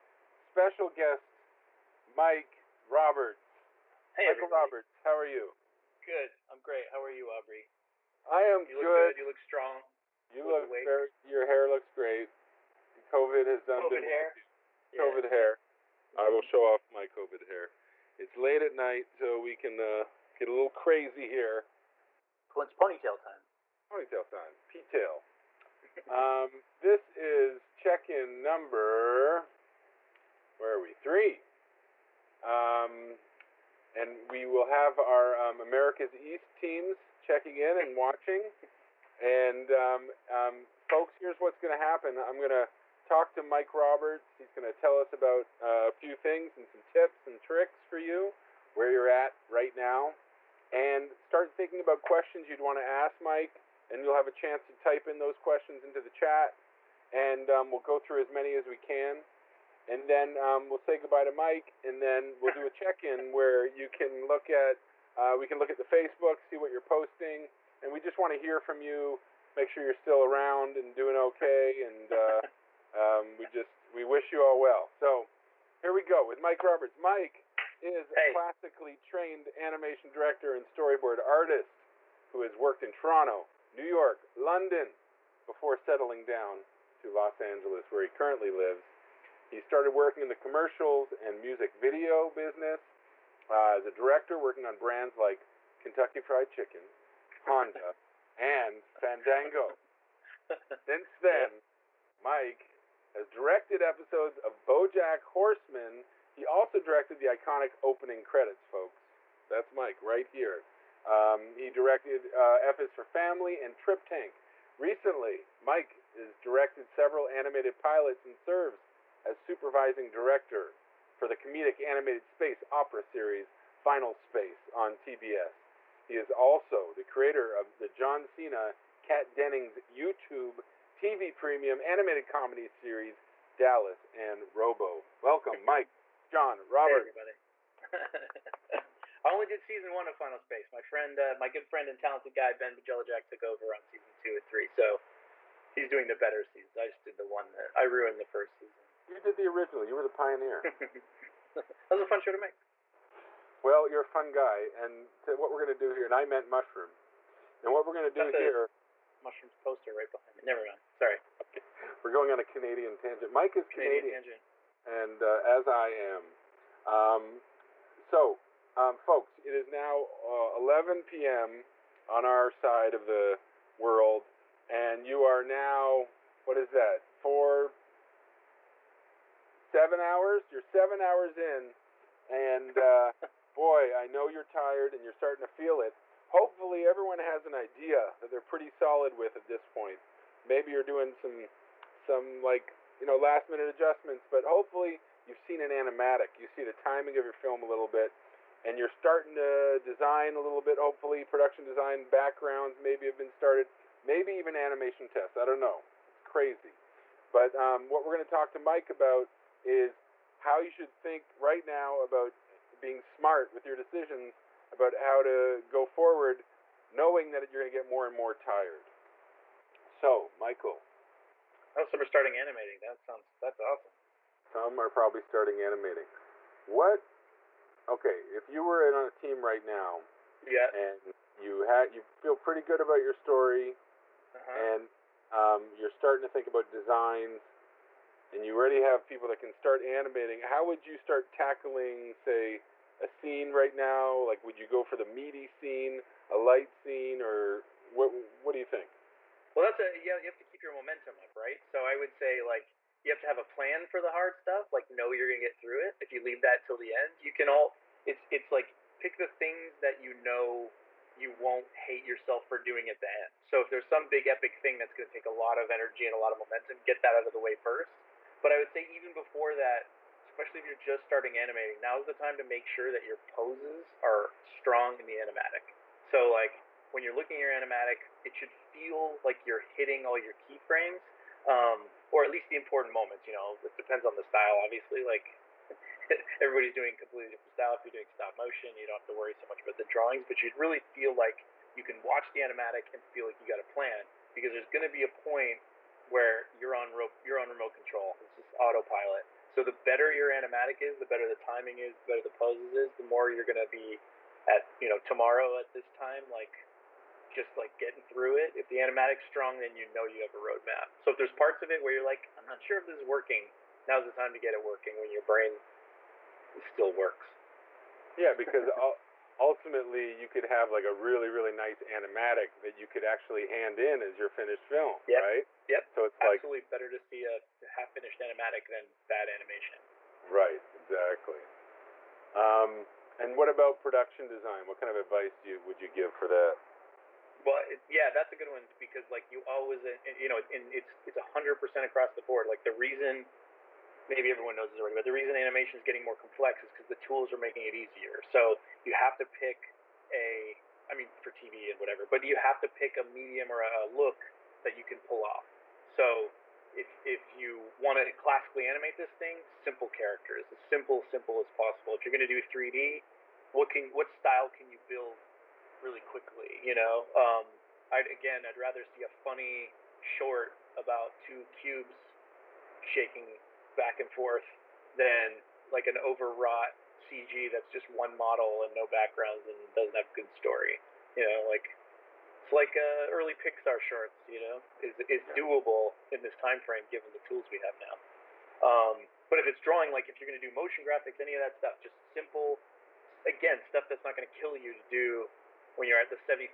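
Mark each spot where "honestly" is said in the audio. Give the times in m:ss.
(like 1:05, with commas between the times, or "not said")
not said.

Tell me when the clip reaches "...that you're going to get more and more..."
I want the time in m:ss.
3:37.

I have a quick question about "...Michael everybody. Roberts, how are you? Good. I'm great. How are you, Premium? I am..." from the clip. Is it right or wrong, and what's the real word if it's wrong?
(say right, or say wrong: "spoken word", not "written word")
wrong: "Aubry", not "Premium".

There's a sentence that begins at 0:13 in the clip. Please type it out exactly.
COVID has done COVID been hair.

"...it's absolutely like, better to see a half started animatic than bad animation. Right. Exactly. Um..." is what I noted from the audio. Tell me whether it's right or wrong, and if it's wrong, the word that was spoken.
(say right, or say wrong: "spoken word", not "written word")
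wrong: "finished", not "started".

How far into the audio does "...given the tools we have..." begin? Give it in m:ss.
6:26.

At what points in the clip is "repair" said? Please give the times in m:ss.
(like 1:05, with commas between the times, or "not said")
not said.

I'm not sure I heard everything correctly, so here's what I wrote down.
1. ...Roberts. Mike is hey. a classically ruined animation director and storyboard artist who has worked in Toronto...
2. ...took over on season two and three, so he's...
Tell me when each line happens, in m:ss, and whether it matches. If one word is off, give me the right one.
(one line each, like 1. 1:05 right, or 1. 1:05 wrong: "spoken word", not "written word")
1. 1:16 wrong: "trained", not "ruined"
2. 2:23 right.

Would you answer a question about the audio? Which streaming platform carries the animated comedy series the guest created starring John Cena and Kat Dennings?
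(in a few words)
YouTube TV Premium.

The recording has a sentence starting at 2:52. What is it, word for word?
on our side of the world, and you are now what is that?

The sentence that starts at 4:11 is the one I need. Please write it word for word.
So I would say like you have to have a plan for the hard stuff.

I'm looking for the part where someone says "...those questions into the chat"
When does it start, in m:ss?
0:55.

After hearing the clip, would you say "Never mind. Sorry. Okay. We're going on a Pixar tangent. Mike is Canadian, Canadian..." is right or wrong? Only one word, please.
wrong.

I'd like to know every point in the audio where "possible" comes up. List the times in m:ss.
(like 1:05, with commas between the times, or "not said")
6:01.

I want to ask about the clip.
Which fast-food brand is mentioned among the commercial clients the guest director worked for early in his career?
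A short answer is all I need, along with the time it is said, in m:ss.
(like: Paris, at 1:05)
Kentucky Fried Chicken, at 1:35.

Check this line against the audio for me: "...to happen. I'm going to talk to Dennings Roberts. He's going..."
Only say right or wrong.
wrong.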